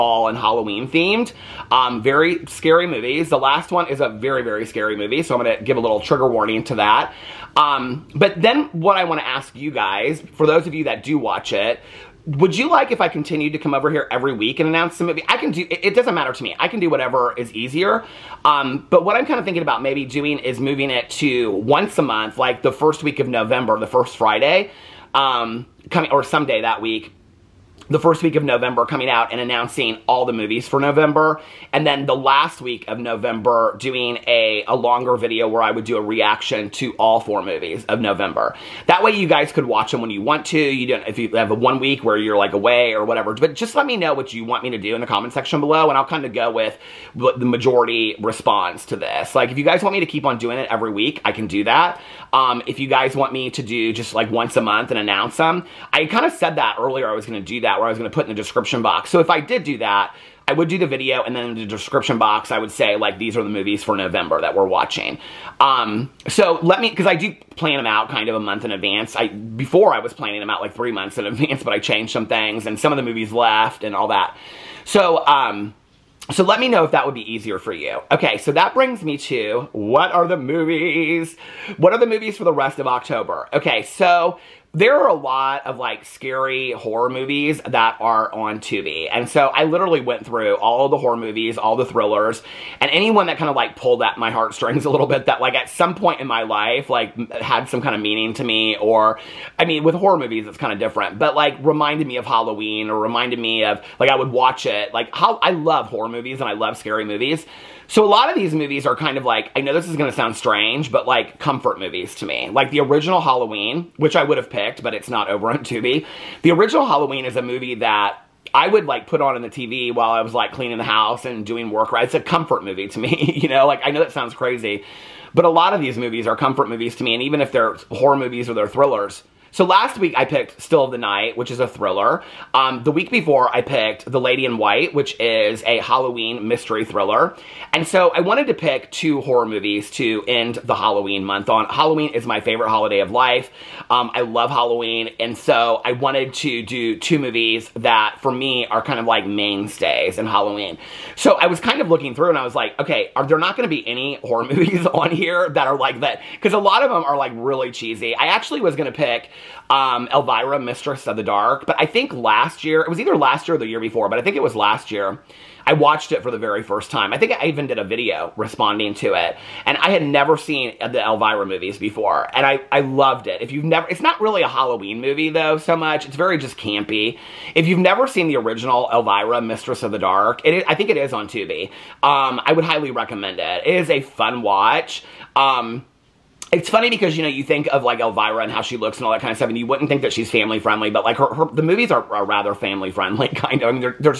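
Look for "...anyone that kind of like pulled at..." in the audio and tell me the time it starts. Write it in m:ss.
1:32.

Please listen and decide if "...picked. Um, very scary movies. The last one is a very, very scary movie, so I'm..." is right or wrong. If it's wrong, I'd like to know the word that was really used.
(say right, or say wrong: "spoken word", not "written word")
wrong: "themed", not "picked".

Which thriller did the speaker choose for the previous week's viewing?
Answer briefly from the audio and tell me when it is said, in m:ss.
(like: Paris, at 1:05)
Still of the Night, at 2:10.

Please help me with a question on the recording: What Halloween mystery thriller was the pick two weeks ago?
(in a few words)
The Lady in White.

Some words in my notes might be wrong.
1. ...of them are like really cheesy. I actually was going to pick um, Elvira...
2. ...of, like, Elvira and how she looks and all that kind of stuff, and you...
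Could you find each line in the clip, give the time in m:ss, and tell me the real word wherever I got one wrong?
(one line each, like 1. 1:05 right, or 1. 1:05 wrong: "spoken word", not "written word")
1. 2:36 right
2. 3:07 right.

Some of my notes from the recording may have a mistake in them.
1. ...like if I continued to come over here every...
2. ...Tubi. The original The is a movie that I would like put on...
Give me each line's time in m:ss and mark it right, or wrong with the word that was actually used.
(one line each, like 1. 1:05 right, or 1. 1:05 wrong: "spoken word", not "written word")
1. 0:12 right
2. 1:55 wrong: "Halloween", not "The".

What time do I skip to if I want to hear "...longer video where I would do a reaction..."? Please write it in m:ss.
0:34.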